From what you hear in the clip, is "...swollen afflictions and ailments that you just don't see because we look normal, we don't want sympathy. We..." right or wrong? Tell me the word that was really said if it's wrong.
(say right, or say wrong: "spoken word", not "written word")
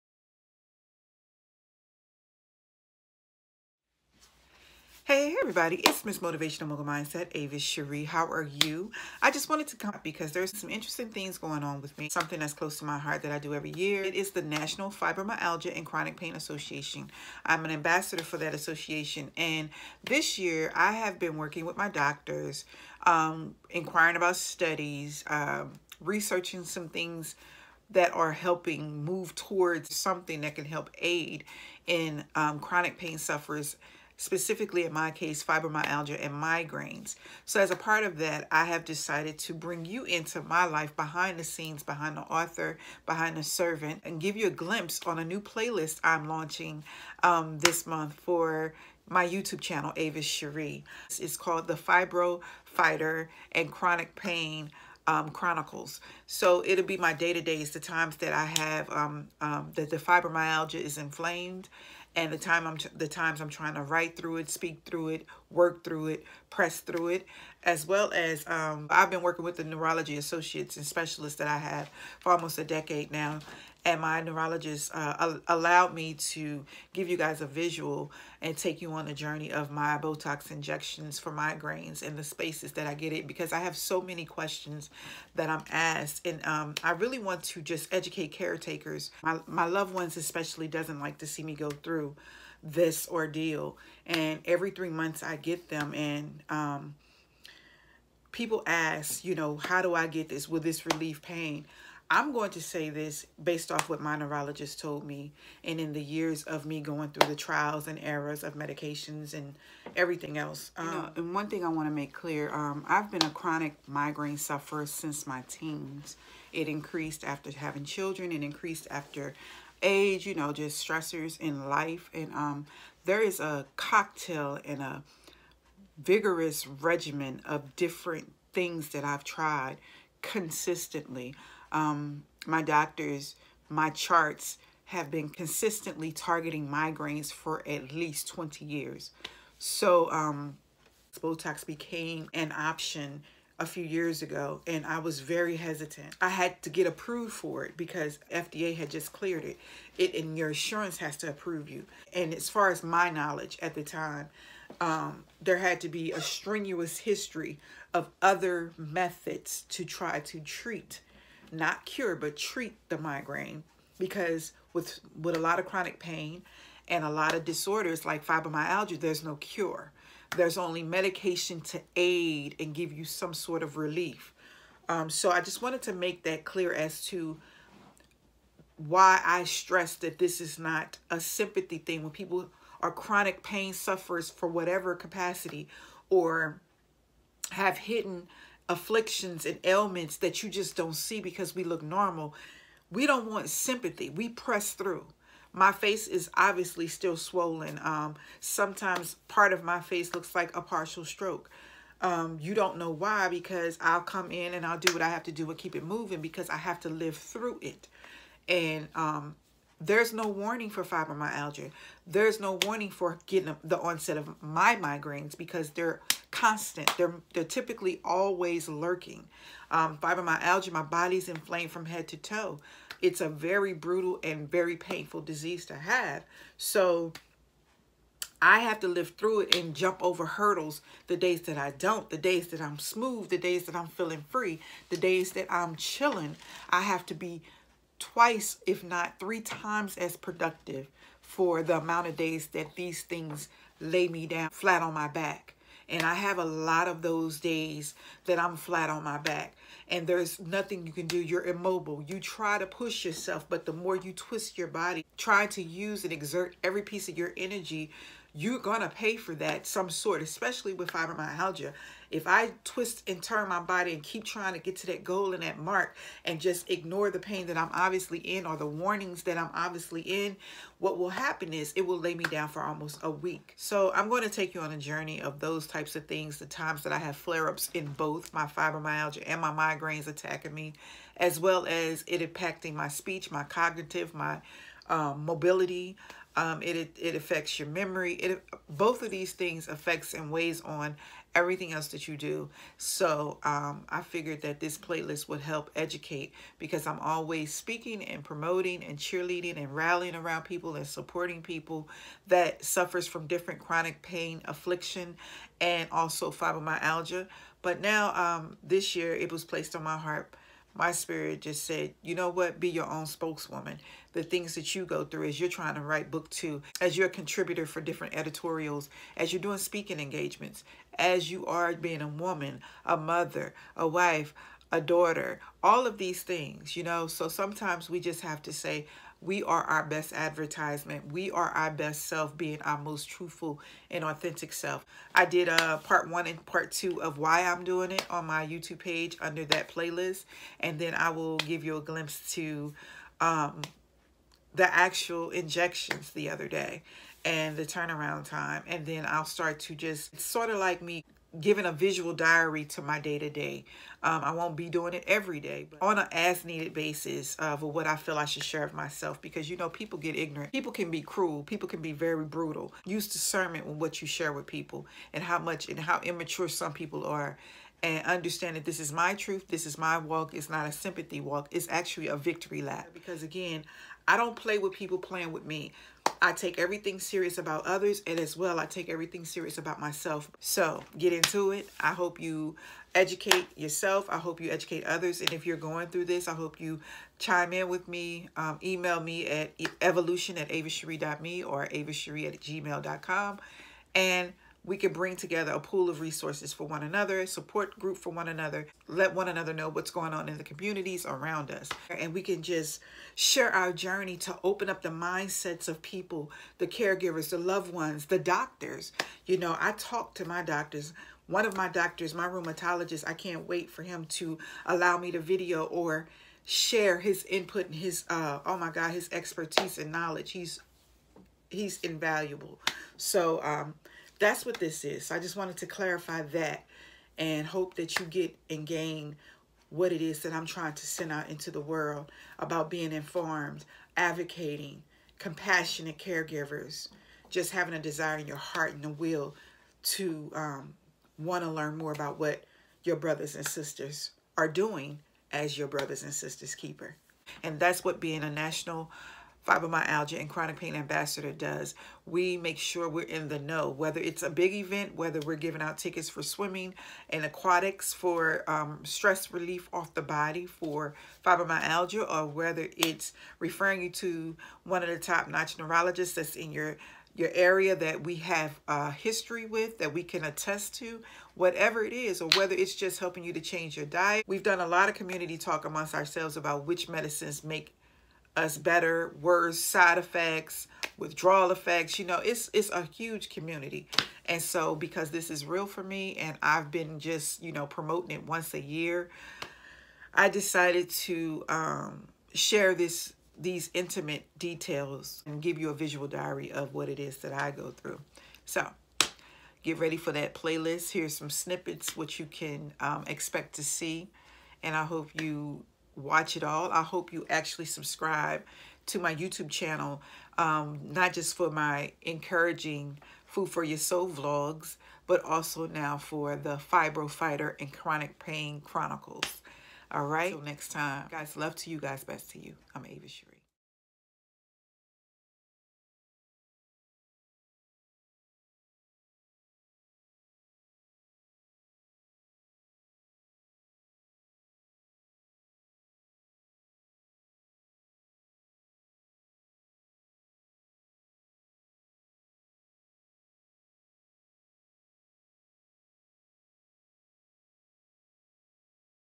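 wrong: "hidden", not "swollen".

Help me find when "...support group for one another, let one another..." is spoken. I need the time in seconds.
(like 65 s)
397 s.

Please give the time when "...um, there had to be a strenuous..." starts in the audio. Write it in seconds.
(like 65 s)
154 s.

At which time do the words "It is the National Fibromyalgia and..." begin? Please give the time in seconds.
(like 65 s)
14 s.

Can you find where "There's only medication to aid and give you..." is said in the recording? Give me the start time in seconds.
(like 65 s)
170 s.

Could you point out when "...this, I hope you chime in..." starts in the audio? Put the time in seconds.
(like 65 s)
386 s.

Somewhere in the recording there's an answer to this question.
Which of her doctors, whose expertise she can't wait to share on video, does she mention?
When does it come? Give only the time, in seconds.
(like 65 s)
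412 s.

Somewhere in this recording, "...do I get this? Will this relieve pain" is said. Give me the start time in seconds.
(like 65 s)
99 s.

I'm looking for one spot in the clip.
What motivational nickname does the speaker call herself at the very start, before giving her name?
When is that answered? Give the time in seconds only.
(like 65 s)
6 s.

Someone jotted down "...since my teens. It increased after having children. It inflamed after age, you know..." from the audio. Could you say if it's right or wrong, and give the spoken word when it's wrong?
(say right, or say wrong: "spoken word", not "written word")
wrong: "increased", not "inflamed".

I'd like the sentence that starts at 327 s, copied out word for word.
So sometimes we just have to say, we are our best advertisement.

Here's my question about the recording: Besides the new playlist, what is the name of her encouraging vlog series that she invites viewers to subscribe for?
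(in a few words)
Food for Your Soul.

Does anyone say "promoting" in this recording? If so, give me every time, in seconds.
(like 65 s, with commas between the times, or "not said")
298 s, 487 s.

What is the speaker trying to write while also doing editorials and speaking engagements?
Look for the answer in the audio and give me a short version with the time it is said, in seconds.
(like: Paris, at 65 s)
Book two, at 316 s.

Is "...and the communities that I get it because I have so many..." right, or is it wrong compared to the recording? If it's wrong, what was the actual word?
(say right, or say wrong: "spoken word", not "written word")
wrong: "spaces", not "communities".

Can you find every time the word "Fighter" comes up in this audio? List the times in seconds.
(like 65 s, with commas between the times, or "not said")
52 s, 517 s.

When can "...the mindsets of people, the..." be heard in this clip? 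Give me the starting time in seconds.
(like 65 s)
404 s.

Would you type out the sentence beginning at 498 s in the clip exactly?
So get ready for that playlist.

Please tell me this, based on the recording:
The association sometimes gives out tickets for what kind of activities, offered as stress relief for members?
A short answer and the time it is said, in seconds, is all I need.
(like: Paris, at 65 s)
Swimming and aquatics, at 456 s.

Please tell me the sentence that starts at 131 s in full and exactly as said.
Um, my doctors, my charts have been consistently targeting migraines for at least 20 years.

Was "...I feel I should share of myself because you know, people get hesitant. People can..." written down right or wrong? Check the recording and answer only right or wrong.
wrong.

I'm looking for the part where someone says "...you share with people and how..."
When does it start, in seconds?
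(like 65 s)
364 s.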